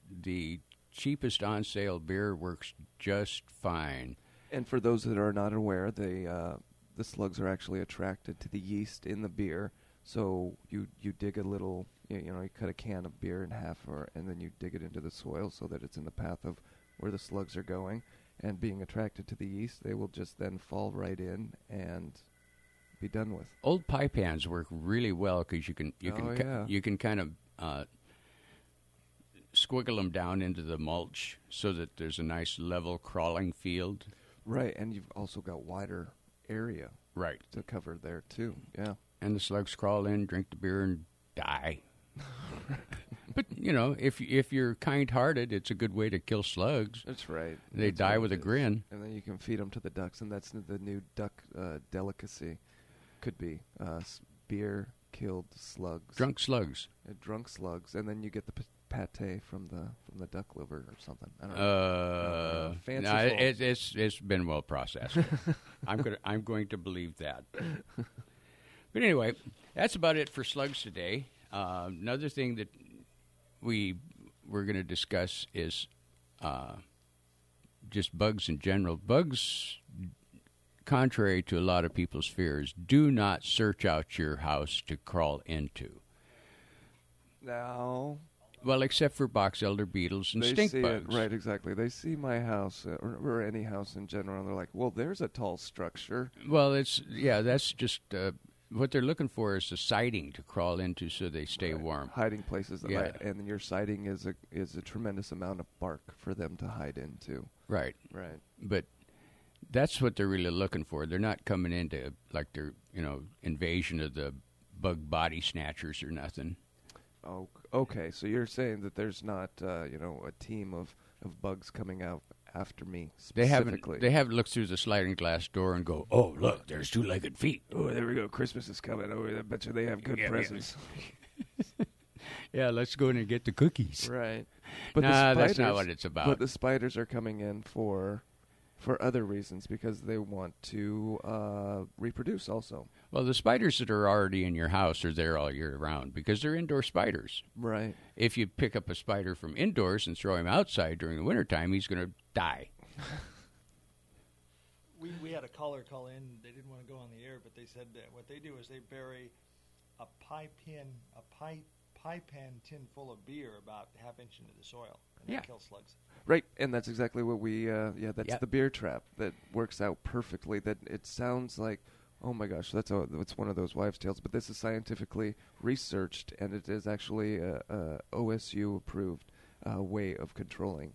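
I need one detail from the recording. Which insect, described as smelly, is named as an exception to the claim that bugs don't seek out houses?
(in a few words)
box elder beetles.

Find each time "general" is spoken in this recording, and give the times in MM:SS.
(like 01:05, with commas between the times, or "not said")
01:18, 01:34.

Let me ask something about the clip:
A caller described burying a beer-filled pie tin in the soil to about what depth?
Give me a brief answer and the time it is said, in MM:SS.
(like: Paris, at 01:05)
half inch, at 02:43.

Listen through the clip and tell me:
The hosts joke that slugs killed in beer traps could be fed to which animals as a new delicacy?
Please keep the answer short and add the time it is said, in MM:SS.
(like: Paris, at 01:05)
ducks, at 00:49.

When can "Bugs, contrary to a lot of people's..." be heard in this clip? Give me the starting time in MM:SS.
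01:18.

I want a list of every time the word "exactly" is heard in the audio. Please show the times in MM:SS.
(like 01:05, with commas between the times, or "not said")
01:31, 02:46.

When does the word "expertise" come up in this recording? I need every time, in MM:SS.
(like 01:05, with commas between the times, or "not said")
not said.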